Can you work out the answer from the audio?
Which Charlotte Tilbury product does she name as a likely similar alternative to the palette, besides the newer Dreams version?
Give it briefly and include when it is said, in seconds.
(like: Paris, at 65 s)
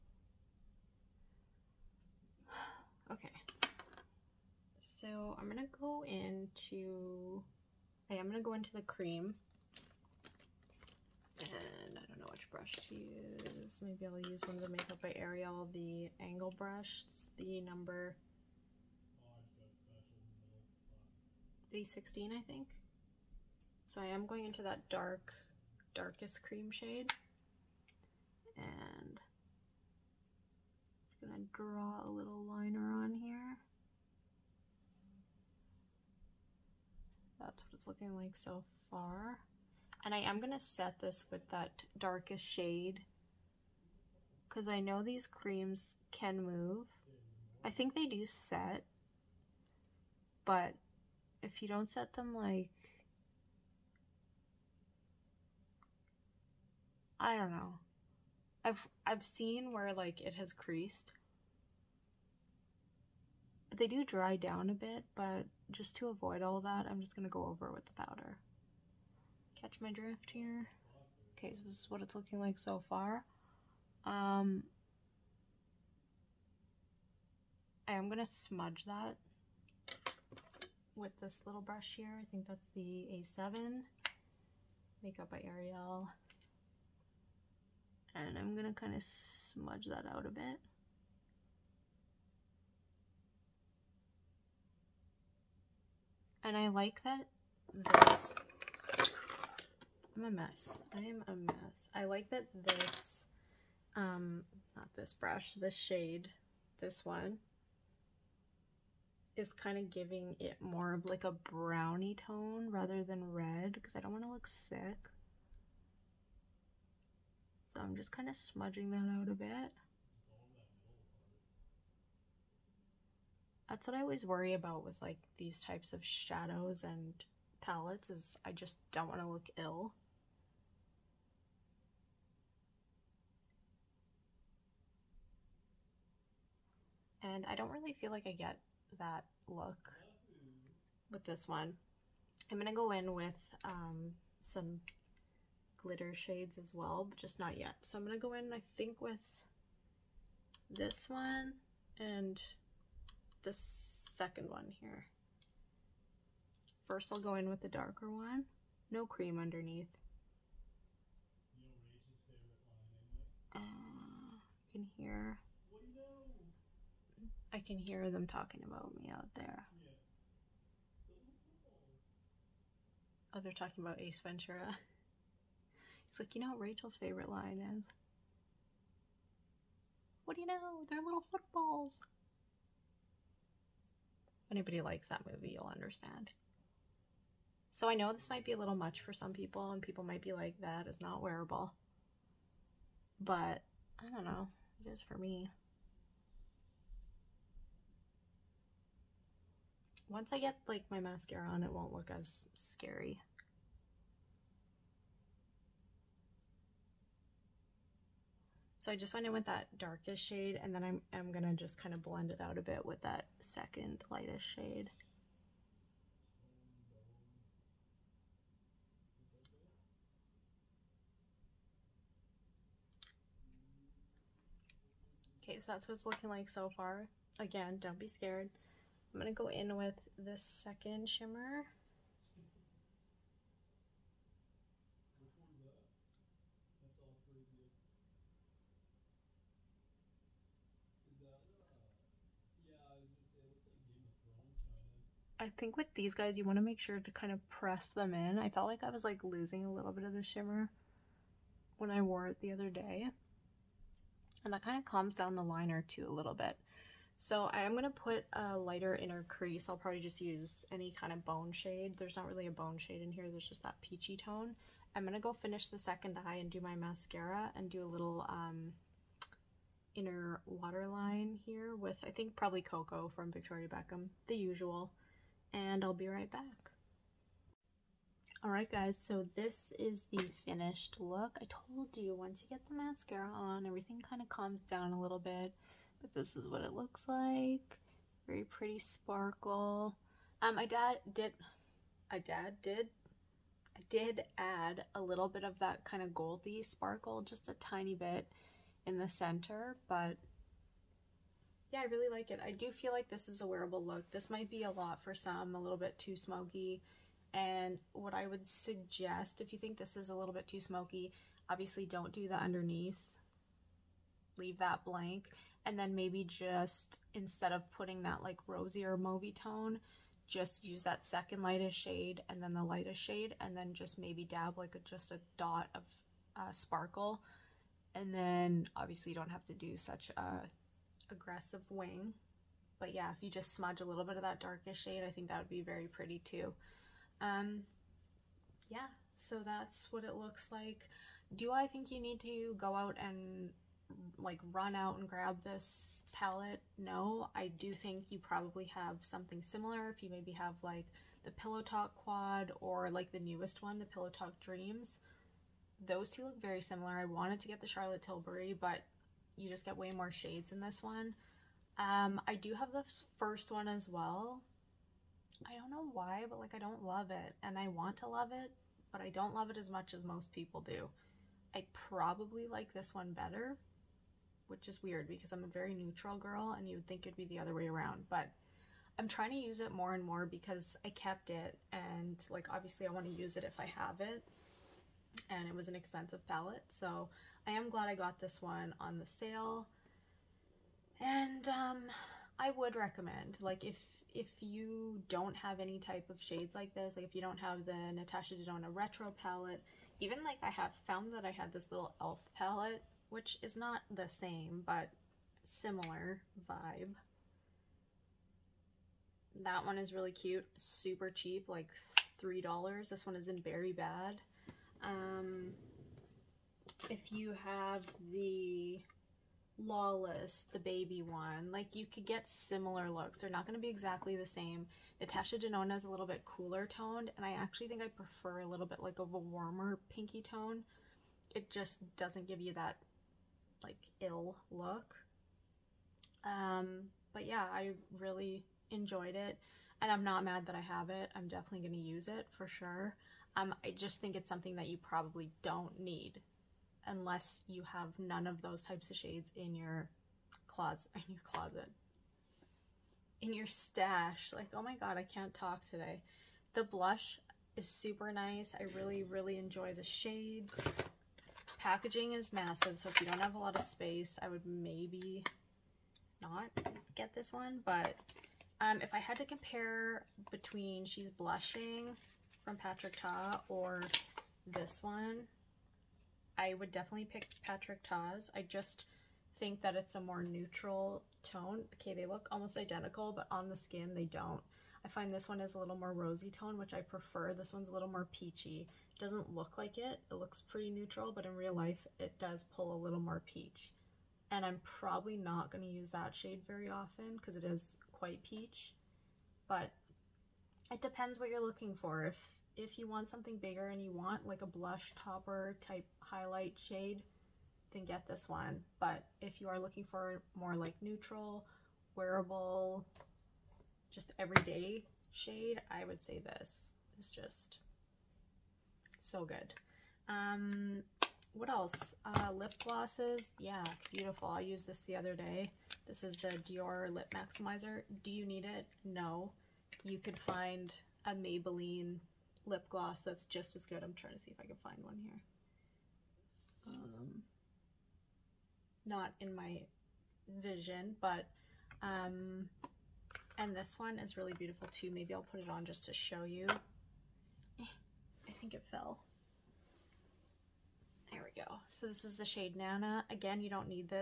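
Pillow Talk Quad, at 351 s.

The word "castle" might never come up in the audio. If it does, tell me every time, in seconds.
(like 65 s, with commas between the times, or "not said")
not said.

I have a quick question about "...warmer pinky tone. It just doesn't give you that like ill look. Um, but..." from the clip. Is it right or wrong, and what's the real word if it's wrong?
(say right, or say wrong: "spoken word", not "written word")
right.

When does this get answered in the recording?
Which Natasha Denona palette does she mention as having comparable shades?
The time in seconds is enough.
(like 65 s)
398 s.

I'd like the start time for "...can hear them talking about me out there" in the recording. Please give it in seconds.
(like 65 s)
167 s.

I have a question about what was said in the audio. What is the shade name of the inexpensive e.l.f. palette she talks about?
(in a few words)
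Berry Bad.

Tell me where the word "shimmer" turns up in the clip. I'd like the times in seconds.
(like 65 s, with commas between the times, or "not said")
231 s, 250 s.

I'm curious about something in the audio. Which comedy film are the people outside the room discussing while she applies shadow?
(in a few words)
Ace Ventura.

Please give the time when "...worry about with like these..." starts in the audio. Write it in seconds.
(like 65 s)
124 s.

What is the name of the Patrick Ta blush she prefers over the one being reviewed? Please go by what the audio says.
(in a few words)
She's Blushing.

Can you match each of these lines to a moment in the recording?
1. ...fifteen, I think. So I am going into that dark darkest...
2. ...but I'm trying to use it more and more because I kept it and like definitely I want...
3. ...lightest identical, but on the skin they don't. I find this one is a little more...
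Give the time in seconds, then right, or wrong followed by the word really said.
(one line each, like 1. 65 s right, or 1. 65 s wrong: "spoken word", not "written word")
1. 21 s wrong: "sixteen", not "fifteen"
2. 378 s wrong: "obviously", not "definitely"
3. 482 s wrong: "almost", not "lightest".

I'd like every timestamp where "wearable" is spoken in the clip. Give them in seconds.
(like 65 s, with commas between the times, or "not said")
191 s, 303 s, 511 s.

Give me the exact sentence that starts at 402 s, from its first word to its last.
palette, which is not the same, but similar vibe.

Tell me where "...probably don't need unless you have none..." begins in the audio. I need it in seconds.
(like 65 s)
444 s.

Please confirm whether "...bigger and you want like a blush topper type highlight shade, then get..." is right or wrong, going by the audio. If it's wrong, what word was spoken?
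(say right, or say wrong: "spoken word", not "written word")
right.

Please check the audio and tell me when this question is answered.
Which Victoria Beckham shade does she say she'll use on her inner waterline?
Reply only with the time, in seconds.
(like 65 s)
272 s.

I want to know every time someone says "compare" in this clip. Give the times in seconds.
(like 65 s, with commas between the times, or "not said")
469 s.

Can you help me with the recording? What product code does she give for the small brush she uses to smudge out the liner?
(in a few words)
A7.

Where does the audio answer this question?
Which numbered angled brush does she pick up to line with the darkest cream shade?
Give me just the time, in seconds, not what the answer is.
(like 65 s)
17 s.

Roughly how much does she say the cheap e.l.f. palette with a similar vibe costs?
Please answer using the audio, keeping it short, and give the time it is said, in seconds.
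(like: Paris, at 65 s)
$3, at 412 s.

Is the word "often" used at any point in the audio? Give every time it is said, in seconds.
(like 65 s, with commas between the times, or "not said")
496 s.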